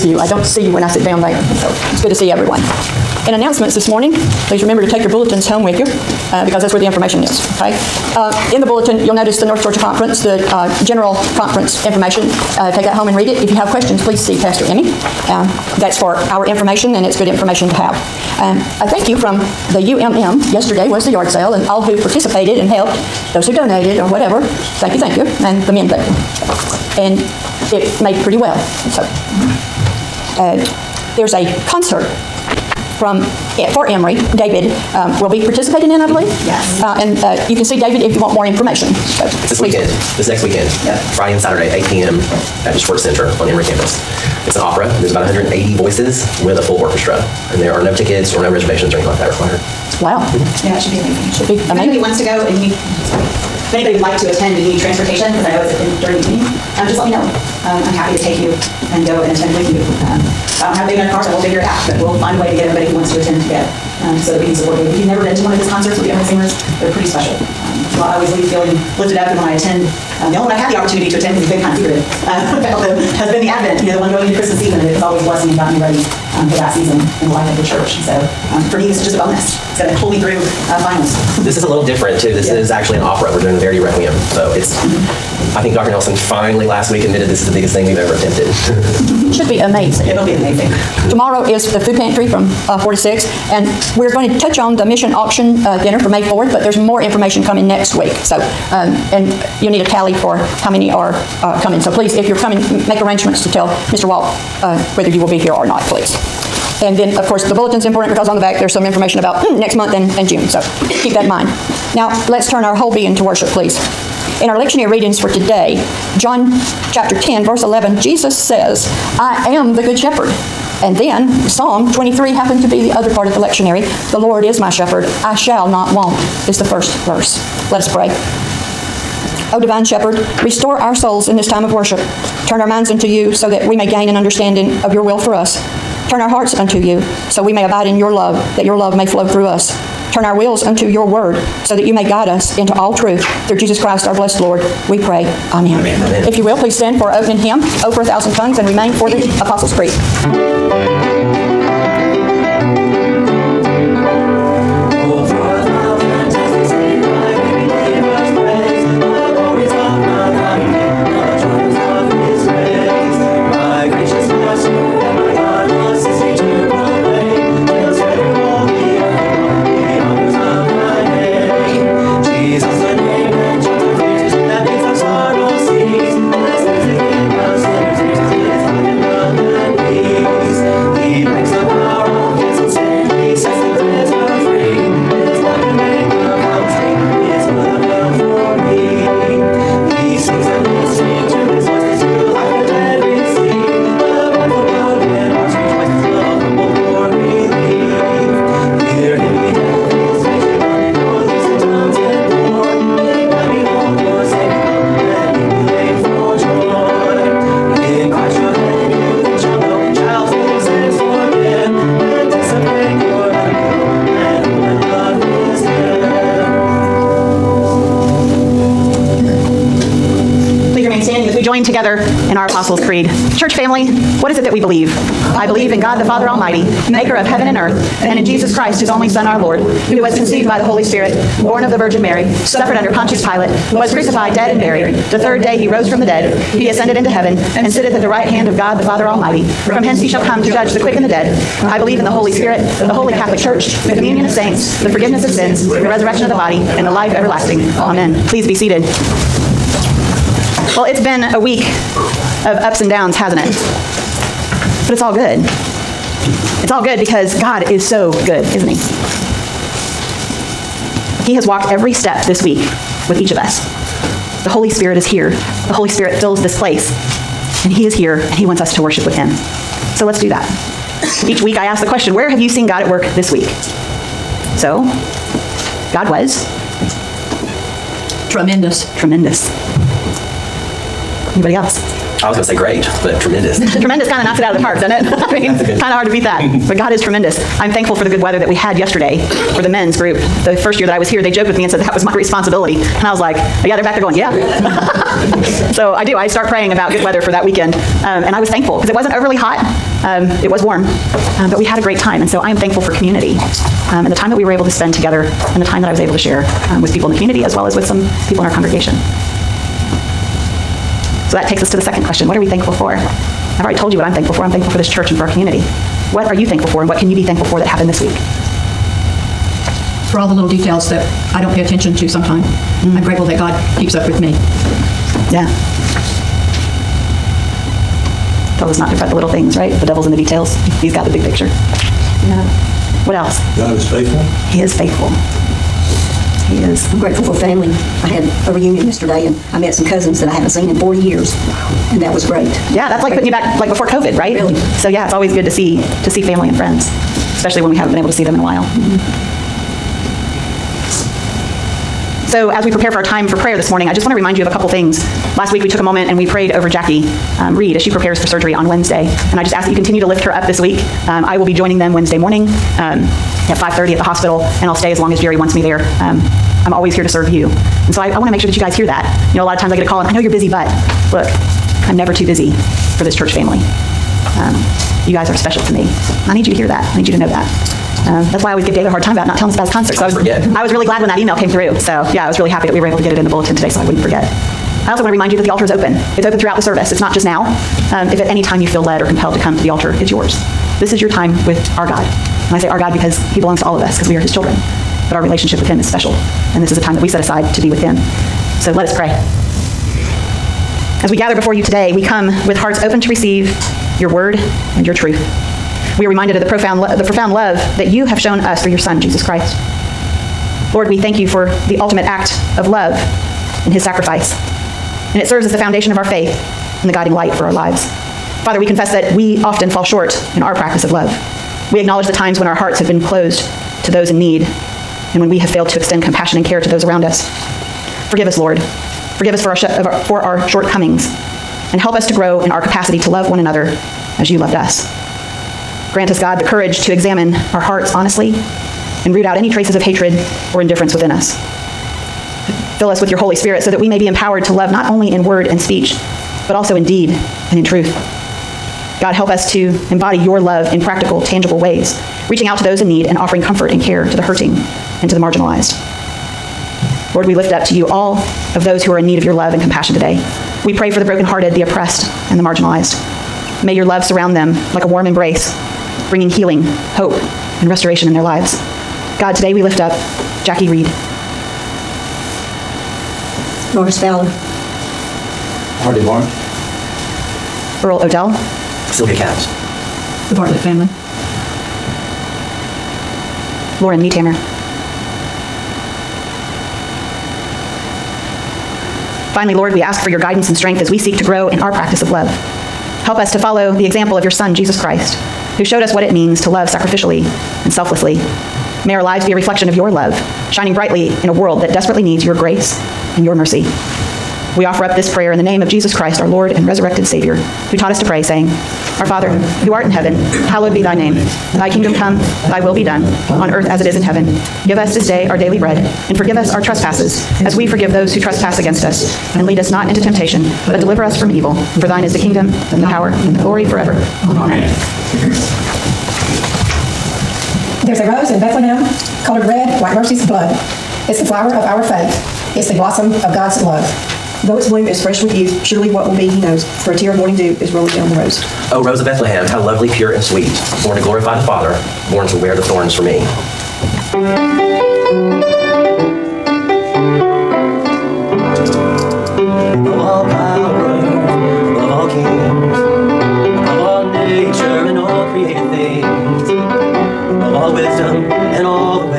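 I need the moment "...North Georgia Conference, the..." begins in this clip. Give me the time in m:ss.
0:09.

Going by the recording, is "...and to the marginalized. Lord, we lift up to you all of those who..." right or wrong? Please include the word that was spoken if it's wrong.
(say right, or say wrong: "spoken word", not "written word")
right.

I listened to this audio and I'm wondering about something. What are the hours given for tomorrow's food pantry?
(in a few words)
4 to 6.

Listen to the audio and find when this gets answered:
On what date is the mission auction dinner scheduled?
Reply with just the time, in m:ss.
1:36.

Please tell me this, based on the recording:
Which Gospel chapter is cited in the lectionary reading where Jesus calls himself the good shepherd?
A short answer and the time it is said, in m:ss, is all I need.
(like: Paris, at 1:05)
John chapter 10, at 1:56.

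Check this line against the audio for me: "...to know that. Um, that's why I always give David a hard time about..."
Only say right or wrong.
right.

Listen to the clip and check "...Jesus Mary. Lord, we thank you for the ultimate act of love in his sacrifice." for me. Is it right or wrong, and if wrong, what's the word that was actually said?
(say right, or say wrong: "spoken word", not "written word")
wrong: "Christ", not "Mary".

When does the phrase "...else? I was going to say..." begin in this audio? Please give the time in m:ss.
4:41.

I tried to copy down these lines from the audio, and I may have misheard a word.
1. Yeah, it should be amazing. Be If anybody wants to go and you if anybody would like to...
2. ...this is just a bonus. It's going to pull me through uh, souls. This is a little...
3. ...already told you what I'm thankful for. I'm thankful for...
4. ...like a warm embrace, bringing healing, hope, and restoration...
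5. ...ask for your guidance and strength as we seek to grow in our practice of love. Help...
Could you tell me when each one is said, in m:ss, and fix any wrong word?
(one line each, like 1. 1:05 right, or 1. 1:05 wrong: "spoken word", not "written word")
1. 0:50 right
2. 1:18 wrong: "finals", not "souls"
3. 5:13 right
4. 7:44 right
5. 8:09 right.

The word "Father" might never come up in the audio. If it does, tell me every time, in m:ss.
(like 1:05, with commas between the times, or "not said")
3:46, 3:58, 6:58, 8:29, 9:01.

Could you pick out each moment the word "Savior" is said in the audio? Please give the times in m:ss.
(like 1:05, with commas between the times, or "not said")
8:27.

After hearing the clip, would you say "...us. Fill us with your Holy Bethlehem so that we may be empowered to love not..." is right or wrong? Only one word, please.
wrong.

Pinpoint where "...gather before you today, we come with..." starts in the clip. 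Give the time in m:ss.
6:41.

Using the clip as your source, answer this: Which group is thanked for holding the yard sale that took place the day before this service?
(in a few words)
UMM.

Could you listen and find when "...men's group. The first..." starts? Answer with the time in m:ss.
4:49.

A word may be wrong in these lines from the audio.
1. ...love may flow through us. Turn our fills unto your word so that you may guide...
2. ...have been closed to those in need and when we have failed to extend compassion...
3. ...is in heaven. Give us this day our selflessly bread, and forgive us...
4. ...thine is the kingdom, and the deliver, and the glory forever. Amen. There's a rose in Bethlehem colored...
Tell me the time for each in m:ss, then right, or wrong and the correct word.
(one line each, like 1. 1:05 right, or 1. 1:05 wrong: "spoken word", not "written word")
1. 2:18 wrong: "wills", not "fills"
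2. 7:02 right
3. 8:33 wrong: "daily", not "selflessly"
4. 8:41 wrong: "power", not "deliver".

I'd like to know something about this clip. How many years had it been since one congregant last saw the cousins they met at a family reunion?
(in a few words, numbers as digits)
40.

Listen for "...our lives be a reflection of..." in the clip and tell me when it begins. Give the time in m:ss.
8:18.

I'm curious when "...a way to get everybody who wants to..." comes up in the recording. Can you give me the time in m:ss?
1:02.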